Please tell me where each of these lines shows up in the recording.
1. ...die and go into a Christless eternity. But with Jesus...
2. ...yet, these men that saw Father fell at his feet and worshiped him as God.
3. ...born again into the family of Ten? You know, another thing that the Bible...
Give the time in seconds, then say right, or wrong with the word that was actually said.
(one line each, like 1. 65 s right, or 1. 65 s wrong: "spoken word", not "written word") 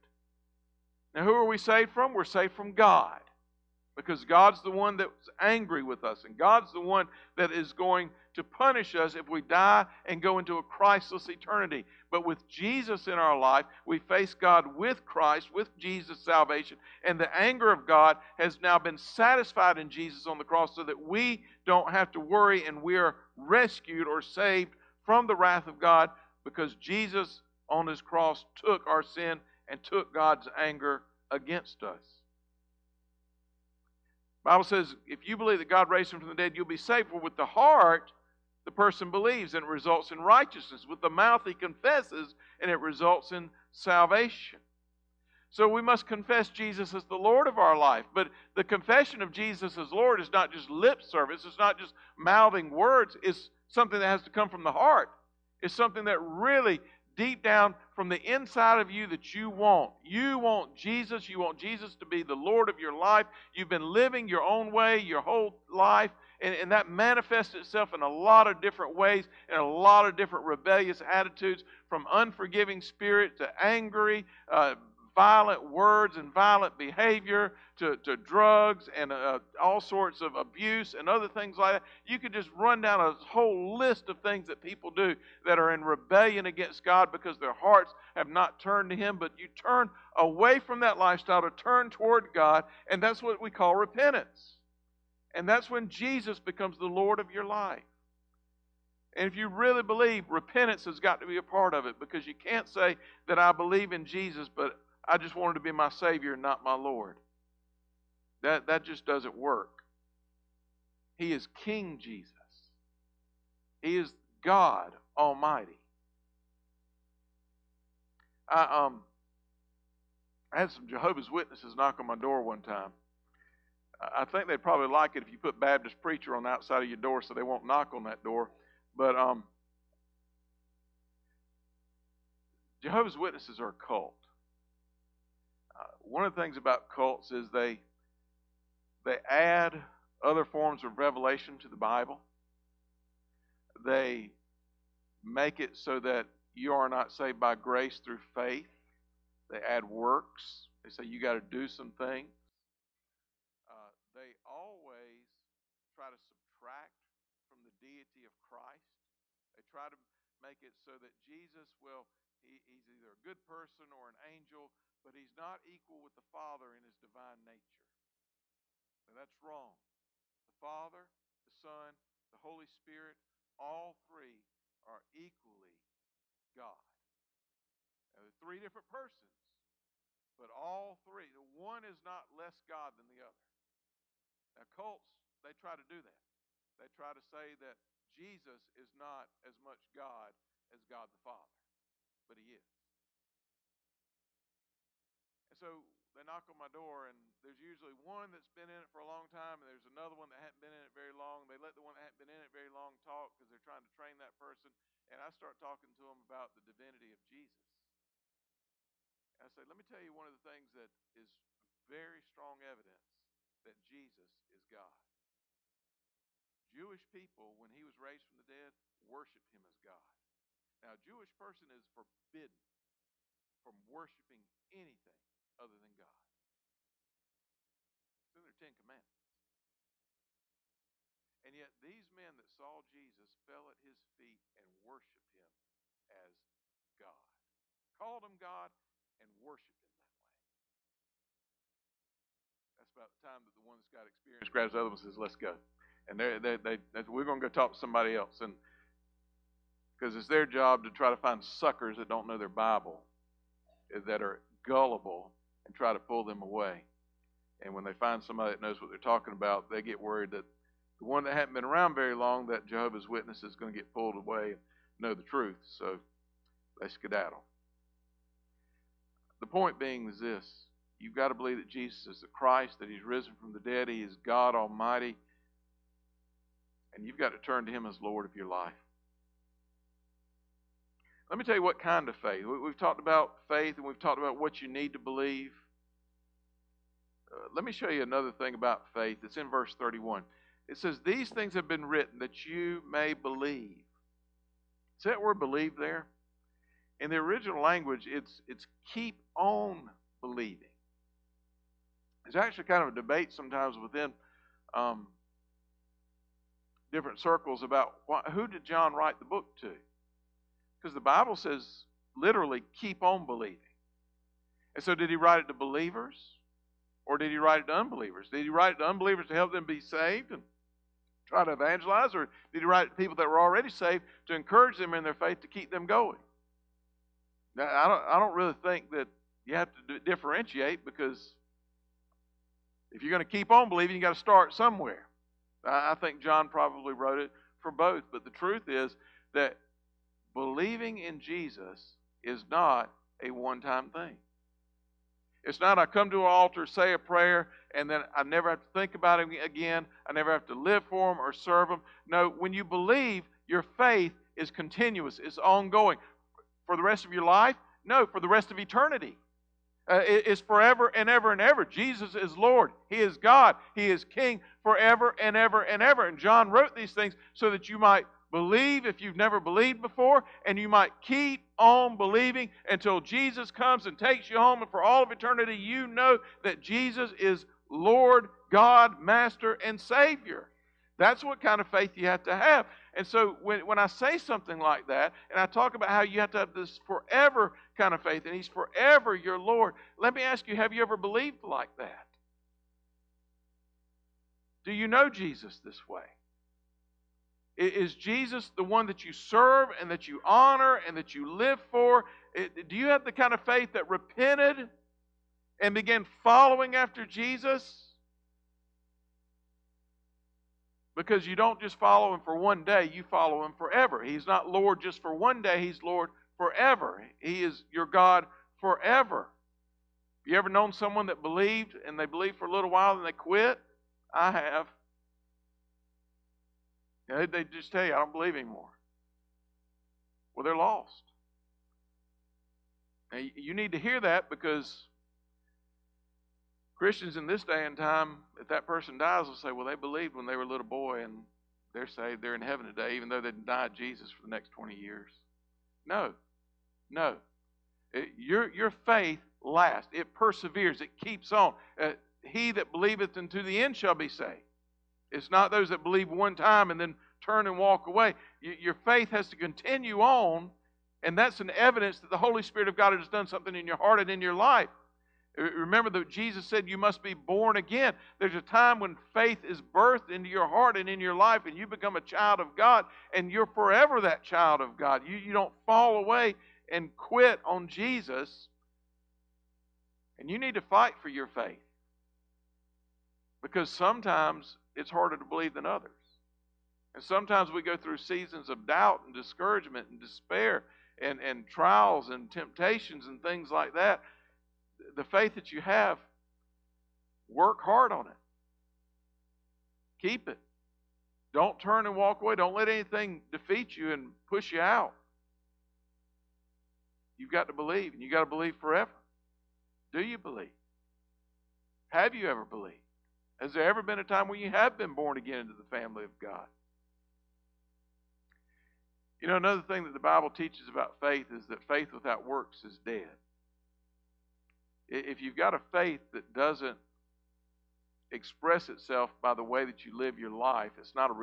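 1. 9 s right
2. 231 s wrong: "Jesus", not "Father"
3. 514 s wrong: "God", not "Ten".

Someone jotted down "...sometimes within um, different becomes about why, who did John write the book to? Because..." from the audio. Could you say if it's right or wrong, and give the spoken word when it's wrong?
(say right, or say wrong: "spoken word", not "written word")
wrong: "circles", not "becomes".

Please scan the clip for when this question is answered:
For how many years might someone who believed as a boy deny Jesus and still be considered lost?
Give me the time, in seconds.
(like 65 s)
444 s.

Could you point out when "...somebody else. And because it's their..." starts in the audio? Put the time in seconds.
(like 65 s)
247 s.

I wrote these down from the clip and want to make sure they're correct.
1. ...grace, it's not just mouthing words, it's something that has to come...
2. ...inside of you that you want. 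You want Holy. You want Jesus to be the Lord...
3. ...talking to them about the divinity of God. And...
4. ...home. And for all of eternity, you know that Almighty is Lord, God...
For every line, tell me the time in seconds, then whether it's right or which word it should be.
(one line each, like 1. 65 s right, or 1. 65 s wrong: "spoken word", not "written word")
1. 51 s wrong: "service", not "grace"
2. 58 s wrong: "Jesus", not "Holy"
3. 205 s wrong: "Jesus", not "God"
4. 374 s wrong: "Jesus", not "Almighty".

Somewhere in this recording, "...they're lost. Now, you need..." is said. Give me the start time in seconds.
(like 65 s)
430 s.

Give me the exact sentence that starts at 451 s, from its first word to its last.
Uh, he that believeth unto the end shall be saved.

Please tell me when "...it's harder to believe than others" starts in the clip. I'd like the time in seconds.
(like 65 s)
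484 s.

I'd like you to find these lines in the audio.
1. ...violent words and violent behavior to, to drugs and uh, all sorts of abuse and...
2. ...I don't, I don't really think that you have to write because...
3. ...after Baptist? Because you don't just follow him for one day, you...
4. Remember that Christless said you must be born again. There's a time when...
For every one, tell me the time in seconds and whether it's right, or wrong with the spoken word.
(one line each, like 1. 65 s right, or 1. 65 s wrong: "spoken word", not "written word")
1. 75 s right
2. 327 s wrong: "differentiate", not "write"
3. 406 s wrong: "Jesus", not "Baptist"
4. 465 s wrong: "Jesus", not "Christless".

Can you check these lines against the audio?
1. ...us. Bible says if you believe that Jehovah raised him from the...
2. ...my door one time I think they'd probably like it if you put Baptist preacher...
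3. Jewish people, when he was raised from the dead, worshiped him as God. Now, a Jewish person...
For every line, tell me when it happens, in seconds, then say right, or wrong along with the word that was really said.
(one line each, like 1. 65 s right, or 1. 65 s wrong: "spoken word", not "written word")
1. 31 s wrong: "God", not "Jehovah"
2. 122 s right
3. 216 s right.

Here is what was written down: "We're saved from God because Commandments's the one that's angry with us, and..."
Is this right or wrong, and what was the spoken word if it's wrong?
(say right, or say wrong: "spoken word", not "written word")
wrong: "God", not "Commandments".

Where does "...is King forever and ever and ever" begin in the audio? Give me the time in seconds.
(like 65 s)
363 s.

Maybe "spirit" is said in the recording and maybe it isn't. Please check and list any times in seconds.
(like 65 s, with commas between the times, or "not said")
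72 s, 172 s, 462 s.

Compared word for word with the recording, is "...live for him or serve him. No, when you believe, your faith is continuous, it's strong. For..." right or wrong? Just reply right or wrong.
wrong.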